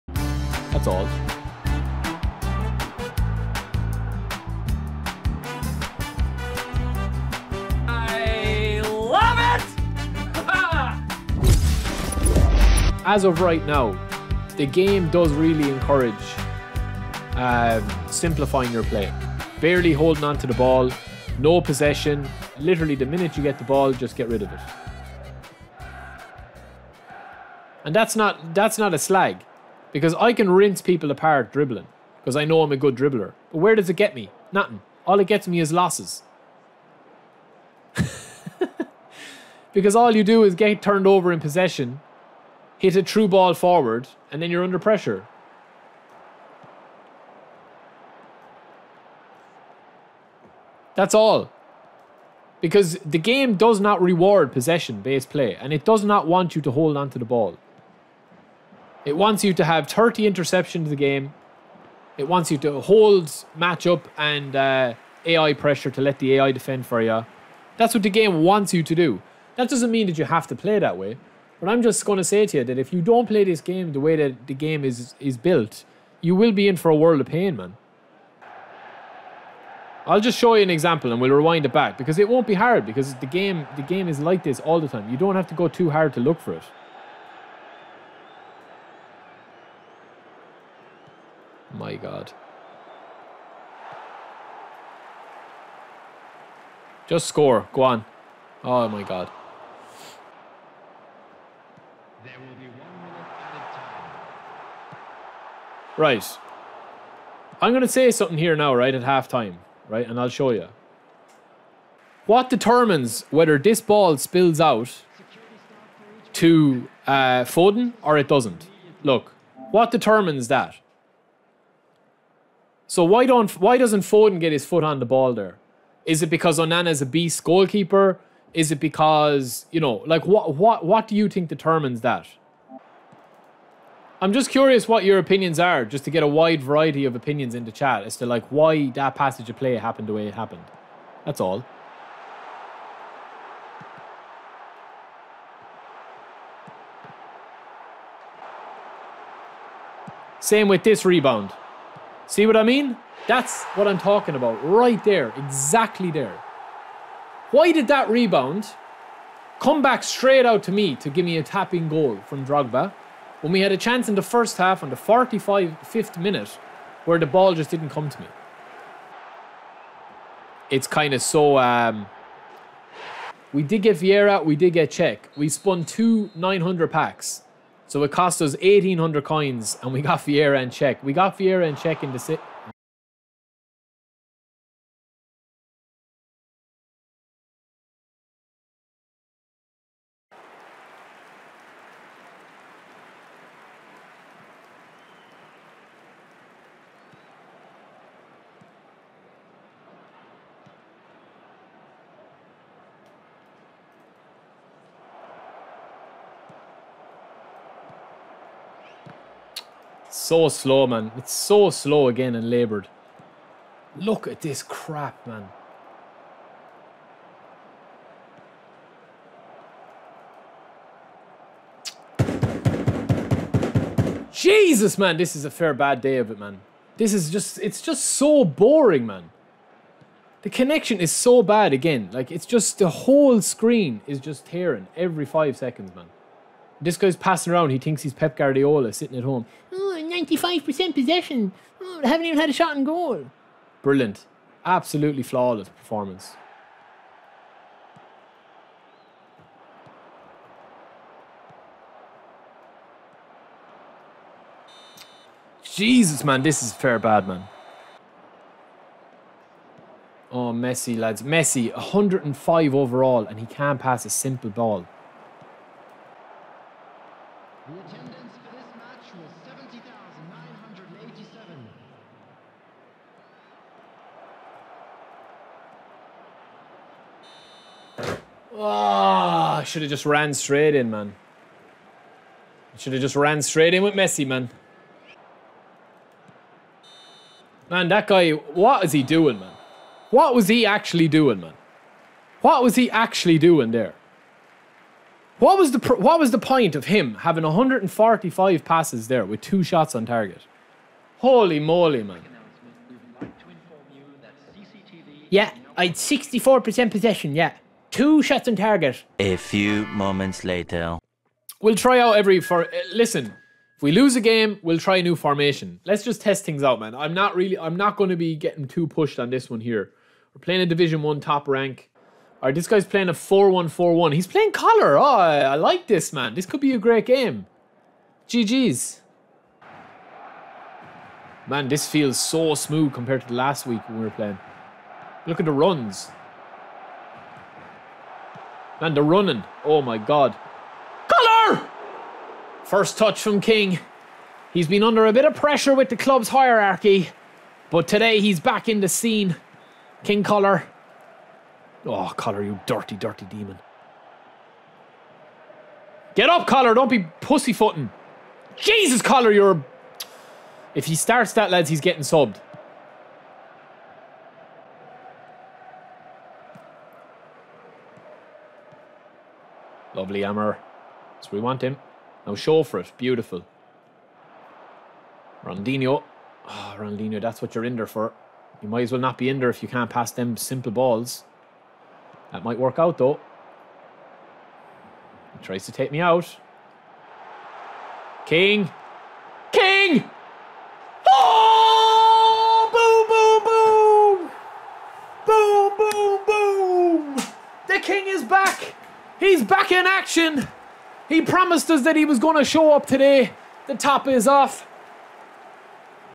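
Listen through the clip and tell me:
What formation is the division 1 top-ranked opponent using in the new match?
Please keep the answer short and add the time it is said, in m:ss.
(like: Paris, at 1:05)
4-1-4-1, at 5:23.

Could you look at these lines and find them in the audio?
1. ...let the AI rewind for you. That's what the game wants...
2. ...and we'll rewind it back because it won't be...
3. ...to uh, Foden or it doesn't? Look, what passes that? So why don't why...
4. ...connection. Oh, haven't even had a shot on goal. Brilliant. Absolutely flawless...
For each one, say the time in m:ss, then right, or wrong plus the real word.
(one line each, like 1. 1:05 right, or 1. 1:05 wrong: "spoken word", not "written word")
1. 1:06 wrong: "defend", not "rewind"
2. 1:21 right
3. 1:56 wrong: "determines", not "passes"
4. 4:00 wrong: "possession", not "connection".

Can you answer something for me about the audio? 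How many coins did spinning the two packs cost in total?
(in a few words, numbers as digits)
1,800.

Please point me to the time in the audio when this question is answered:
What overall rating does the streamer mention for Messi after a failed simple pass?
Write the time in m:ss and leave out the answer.
4:21.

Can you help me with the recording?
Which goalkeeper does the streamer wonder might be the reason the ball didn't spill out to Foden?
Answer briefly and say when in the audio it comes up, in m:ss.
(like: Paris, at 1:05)
Onana, at 2:06.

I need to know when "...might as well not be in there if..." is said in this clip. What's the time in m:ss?
6:18.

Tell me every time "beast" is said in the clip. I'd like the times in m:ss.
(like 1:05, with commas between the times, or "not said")
2:07.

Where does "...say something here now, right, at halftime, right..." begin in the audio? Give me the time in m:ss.
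1:47.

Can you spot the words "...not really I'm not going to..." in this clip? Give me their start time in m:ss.
5:17.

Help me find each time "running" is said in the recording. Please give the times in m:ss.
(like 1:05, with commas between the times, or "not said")
5:39.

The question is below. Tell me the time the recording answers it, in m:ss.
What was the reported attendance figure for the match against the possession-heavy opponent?
4:29.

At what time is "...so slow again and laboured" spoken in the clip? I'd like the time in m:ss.
3:31.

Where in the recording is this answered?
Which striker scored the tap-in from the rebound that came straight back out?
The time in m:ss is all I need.
2:42.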